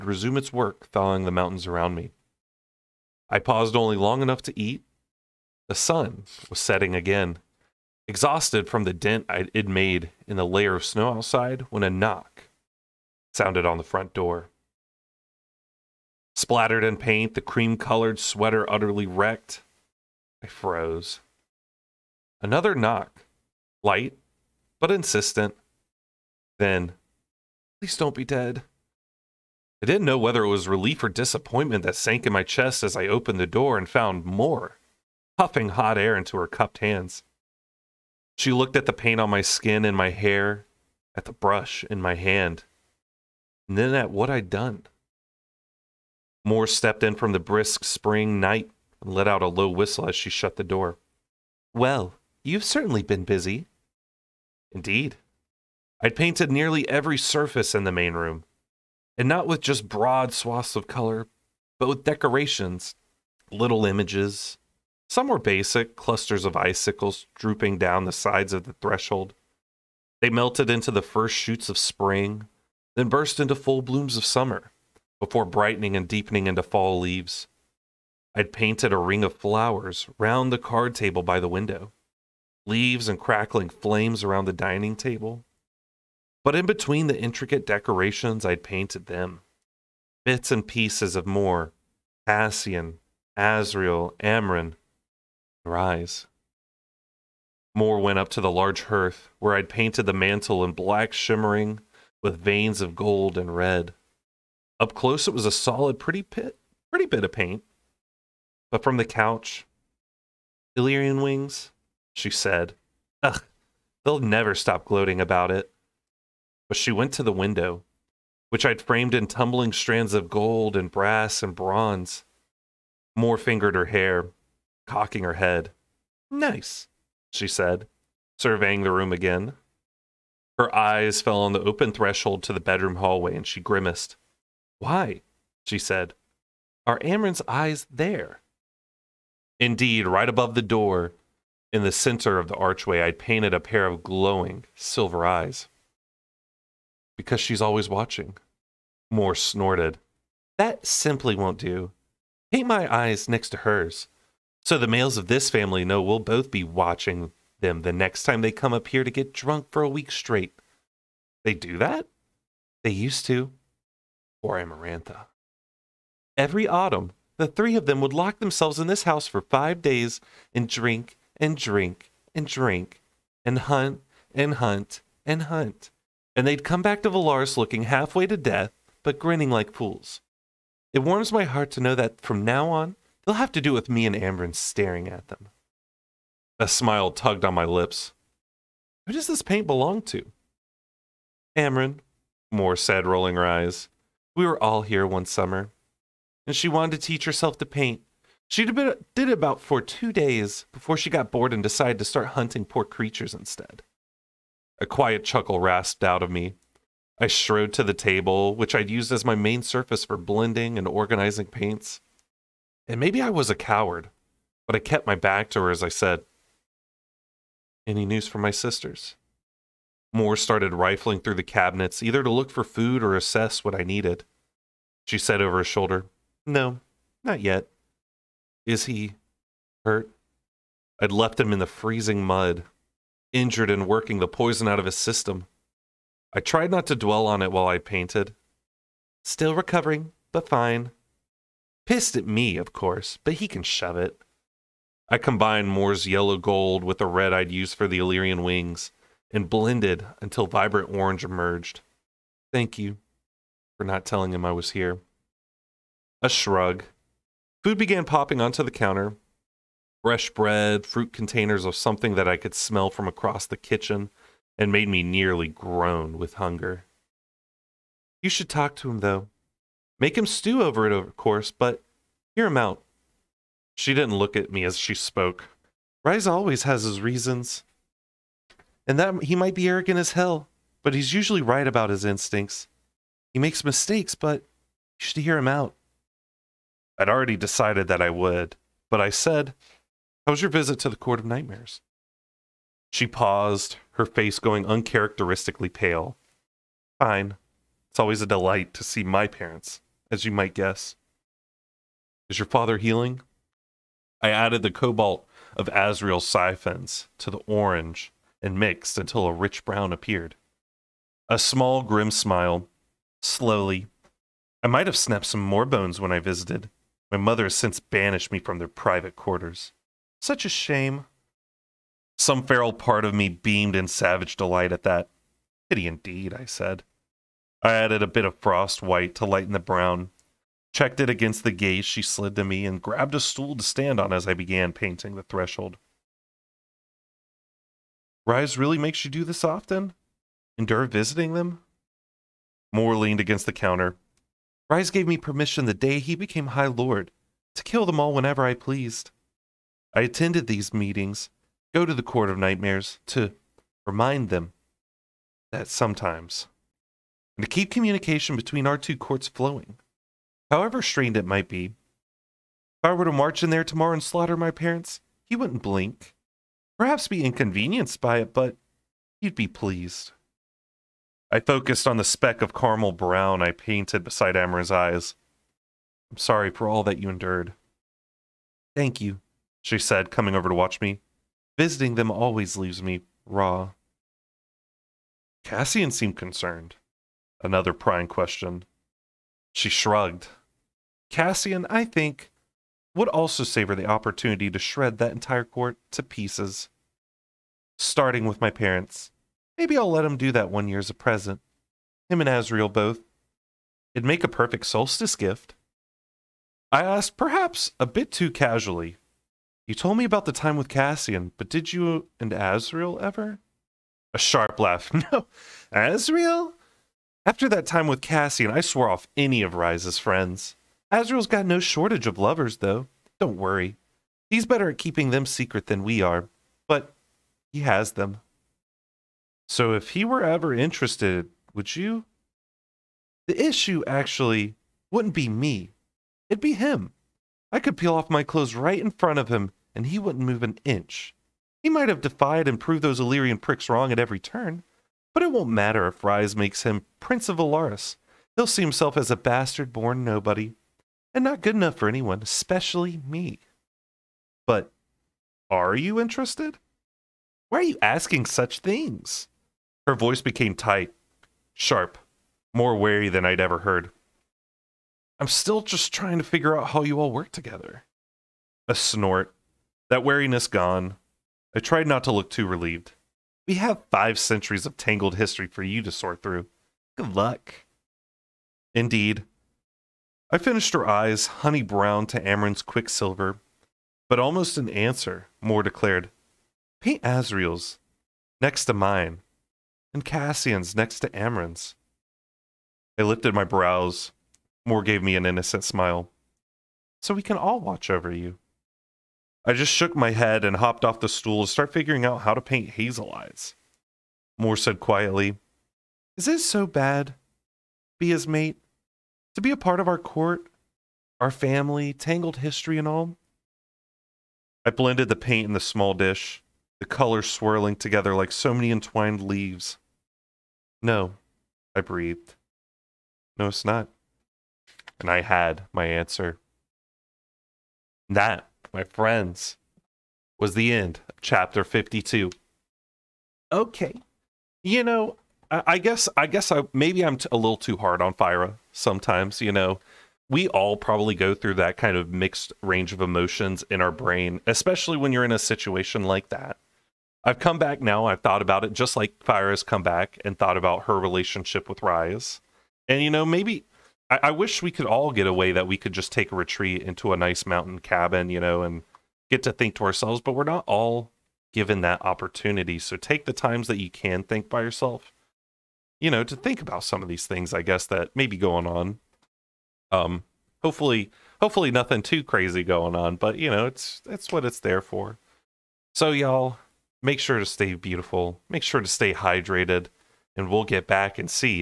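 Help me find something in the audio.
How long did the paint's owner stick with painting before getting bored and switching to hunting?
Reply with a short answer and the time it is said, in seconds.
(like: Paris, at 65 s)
2 days, at 199 s.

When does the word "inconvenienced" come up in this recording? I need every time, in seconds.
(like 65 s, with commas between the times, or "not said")
367 s.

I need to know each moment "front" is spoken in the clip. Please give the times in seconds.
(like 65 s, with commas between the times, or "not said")
13 s, 438 s.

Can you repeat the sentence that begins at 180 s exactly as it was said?
It warms my heart to know that from now on, they'll have to do with me and Amren staring at them.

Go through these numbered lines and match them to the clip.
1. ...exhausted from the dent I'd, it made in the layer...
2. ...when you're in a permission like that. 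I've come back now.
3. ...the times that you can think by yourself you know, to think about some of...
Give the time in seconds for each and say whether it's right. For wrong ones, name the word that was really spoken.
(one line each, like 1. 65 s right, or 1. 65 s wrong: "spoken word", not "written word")
1. 8 s right
2. 544 s wrong: "situation", not "permission"
3. 563 s right.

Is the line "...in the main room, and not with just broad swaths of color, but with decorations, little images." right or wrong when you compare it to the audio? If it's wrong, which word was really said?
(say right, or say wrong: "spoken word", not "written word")
right.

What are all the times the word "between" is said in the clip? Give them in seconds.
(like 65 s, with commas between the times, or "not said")
86 s, 358 s.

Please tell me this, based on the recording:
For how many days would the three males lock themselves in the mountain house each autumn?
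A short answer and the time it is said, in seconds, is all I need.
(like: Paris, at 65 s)
5, at 169 s.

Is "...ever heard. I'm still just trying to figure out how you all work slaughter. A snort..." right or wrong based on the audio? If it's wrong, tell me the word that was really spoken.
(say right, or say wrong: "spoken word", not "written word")
wrong: "together", not "slaughter".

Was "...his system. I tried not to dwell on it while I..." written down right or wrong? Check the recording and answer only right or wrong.
right.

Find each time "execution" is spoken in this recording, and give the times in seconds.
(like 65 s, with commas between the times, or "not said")
not said.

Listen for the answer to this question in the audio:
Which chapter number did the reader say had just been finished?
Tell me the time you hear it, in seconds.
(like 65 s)
531 s.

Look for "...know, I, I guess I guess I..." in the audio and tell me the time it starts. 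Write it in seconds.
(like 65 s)
534 s.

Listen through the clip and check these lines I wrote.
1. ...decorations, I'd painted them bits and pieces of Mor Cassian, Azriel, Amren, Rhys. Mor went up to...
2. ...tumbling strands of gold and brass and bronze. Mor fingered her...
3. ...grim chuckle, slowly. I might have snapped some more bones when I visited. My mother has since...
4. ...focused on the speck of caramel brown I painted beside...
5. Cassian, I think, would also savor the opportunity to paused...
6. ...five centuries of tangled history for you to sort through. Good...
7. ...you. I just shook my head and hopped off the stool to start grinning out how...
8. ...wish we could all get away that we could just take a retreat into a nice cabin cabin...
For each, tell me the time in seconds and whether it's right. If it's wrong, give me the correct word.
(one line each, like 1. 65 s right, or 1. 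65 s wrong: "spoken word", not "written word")
1. 87 s right
2. 119 s right
3. 311 s wrong: "smile", not "chuckle"
4. 371 s right
5. 391 s wrong: "shred", not "paused"
6. 473 s right
7. 498 s wrong: "figuring", not "grinning"
8. 554 s wrong: "mountain", not "cabin".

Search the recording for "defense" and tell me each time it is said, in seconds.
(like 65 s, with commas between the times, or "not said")
not said.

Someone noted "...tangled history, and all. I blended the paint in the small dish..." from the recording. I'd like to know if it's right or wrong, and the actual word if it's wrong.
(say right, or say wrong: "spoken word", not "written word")
right.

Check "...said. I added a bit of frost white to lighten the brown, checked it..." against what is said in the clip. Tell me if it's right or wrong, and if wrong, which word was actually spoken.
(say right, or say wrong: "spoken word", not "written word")
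right.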